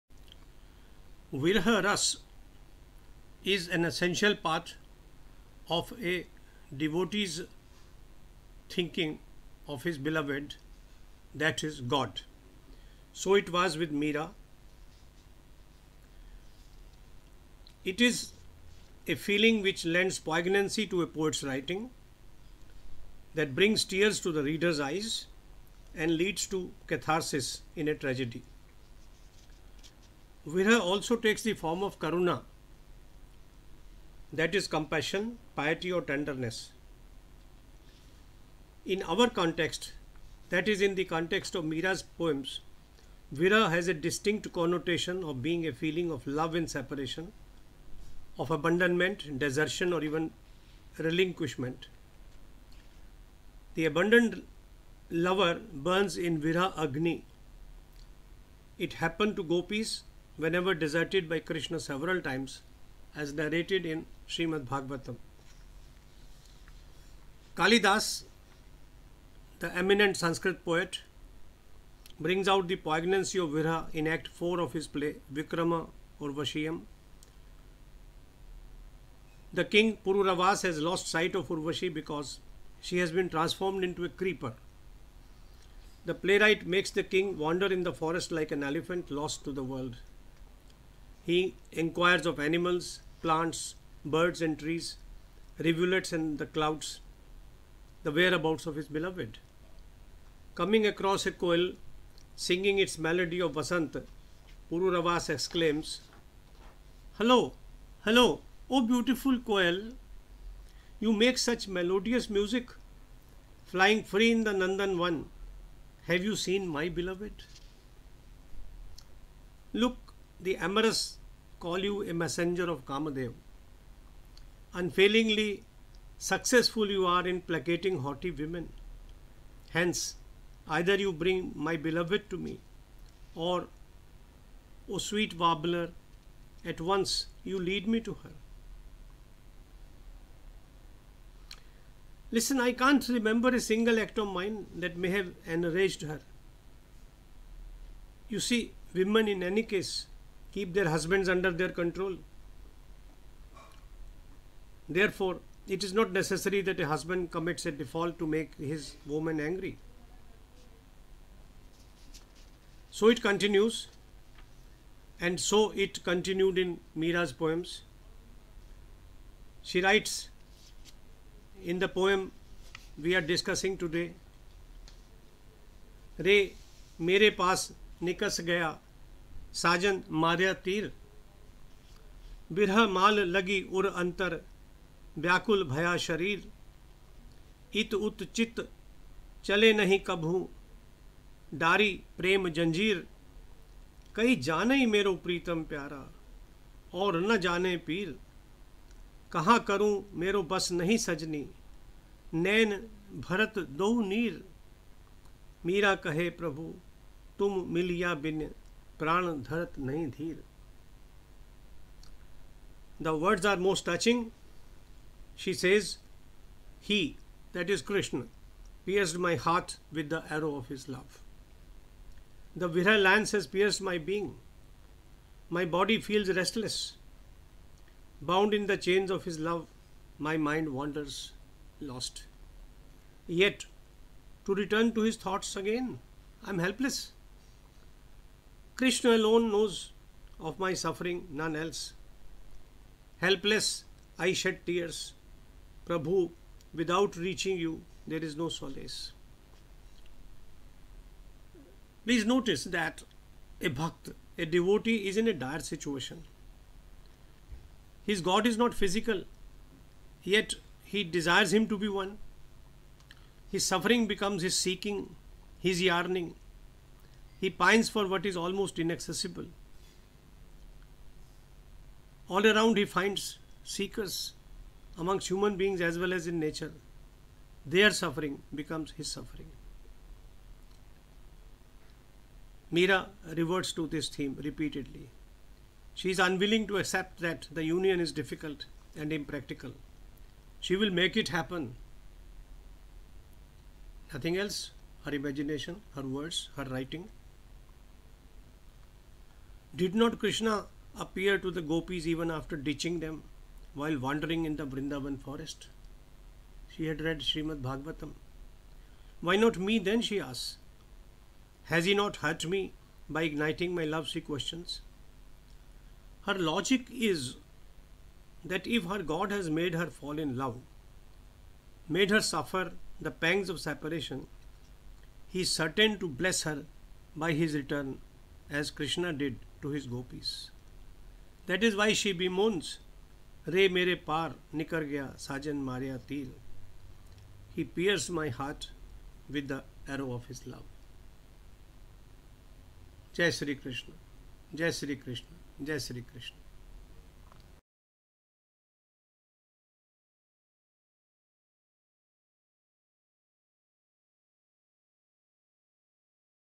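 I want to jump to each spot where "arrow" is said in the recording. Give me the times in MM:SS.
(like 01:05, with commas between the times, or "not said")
03:40, 05:39.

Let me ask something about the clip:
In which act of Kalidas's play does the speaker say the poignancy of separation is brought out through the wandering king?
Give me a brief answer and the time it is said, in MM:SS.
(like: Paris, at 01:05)
Act 4, at 01:14.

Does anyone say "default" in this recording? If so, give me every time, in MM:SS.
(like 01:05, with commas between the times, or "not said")
02:37.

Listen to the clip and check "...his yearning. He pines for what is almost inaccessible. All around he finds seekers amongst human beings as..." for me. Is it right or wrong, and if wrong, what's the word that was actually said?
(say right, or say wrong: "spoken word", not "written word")
right.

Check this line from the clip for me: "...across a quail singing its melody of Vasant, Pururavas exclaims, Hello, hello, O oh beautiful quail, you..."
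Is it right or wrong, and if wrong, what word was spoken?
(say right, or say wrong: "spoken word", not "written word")
right.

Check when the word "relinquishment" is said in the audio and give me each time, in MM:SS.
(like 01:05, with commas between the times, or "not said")
00:50.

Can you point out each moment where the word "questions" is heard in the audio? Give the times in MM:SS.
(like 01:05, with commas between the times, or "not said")
05:14.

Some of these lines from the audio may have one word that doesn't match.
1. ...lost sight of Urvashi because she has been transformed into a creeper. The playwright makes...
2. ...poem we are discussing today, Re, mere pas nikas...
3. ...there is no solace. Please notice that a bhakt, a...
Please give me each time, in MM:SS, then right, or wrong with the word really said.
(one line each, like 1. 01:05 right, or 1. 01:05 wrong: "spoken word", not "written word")
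1. 01:20 right
2. 02:51 right
3. 04:08 right.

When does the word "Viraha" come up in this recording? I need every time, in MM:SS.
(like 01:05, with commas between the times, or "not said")
00:01, 00:30, 00:43, 00:56, 01:13.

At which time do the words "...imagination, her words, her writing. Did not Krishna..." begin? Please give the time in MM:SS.
04:55.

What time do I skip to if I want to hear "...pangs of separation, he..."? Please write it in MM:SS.
05:23.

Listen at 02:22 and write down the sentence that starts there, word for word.
Listen, I can't remember a single act of mine that may have enraged her.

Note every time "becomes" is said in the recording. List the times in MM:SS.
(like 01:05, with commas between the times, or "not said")
04:24, 04:38.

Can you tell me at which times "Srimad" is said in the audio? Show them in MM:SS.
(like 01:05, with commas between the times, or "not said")
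01:04, 05:07.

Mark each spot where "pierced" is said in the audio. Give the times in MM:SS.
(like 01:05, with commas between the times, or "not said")
03:38, 03:43, 05:37.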